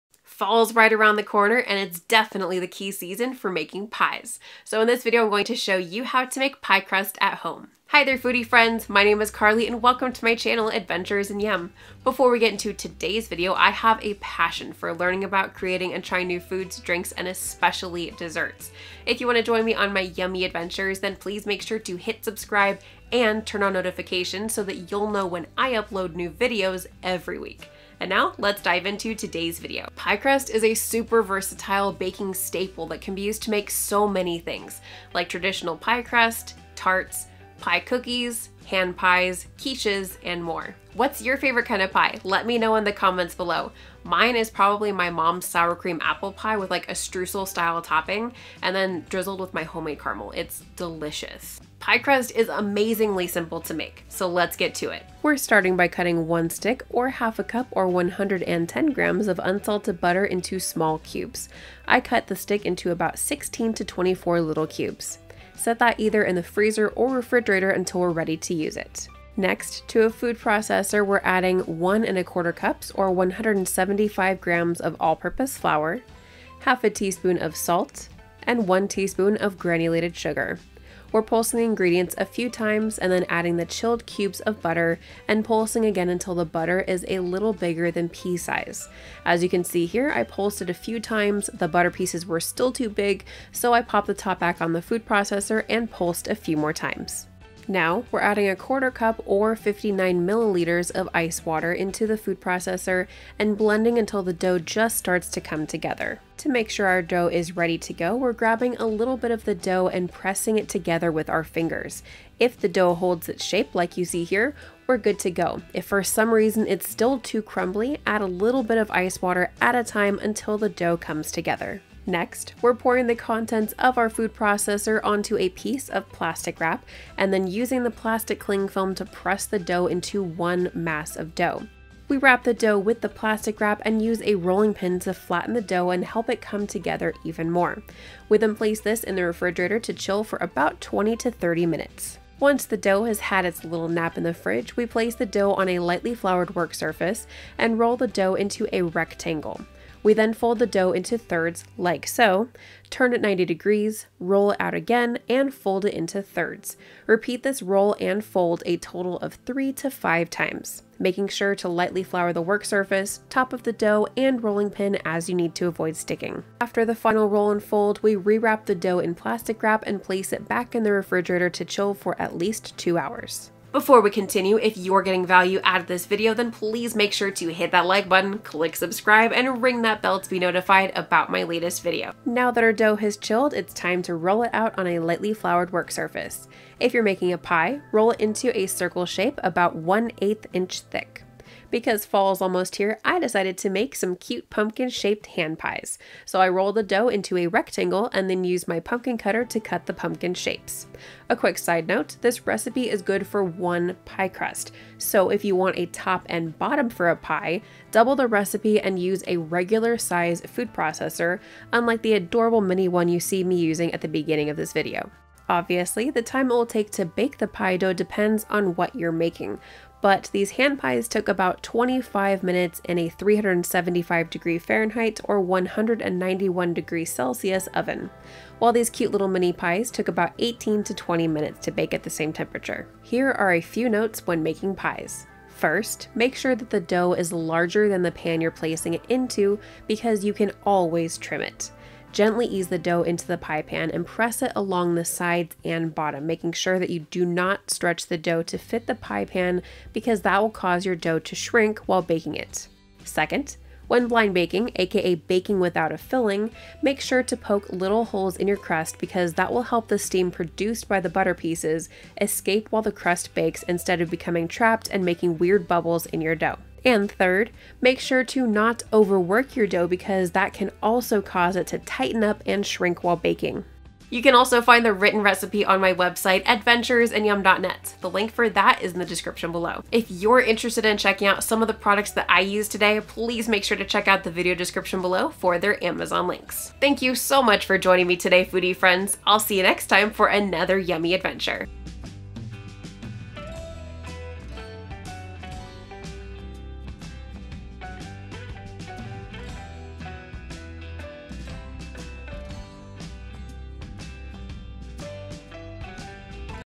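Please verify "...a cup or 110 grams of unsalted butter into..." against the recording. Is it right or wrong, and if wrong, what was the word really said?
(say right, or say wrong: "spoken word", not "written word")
right.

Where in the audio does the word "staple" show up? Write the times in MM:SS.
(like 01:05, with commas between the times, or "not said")
00:32.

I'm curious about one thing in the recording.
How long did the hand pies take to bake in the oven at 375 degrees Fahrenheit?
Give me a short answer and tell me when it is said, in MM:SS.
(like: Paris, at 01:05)
25 minutes, at 03:41.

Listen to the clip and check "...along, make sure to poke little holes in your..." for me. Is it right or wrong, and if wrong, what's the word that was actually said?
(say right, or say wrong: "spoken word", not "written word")
wrong: "filling", not "along".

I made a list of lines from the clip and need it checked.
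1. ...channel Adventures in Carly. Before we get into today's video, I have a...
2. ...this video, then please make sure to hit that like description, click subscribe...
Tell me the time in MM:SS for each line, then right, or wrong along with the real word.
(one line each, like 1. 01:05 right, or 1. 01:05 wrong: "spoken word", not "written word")
1. 00:10 wrong: "Yum", not "Carly"
2. 02:55 wrong: "button", not "description".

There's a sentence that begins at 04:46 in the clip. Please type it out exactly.
Thank you so much for joining me today, foodie friends.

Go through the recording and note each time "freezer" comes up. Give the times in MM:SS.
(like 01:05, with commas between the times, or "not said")
01:06.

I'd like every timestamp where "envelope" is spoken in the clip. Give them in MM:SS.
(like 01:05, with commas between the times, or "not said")
not said.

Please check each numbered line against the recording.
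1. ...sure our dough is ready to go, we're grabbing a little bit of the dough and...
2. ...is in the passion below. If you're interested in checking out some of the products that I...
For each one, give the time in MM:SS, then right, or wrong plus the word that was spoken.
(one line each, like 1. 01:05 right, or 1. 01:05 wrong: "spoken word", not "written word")
1. 01:46 right
2. 04:38 wrong: "description", not "passion".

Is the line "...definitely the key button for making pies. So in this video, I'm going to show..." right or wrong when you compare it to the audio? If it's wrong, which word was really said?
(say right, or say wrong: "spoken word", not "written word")
wrong: "season", not "button".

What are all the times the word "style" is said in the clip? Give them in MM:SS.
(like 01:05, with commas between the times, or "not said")
00:47.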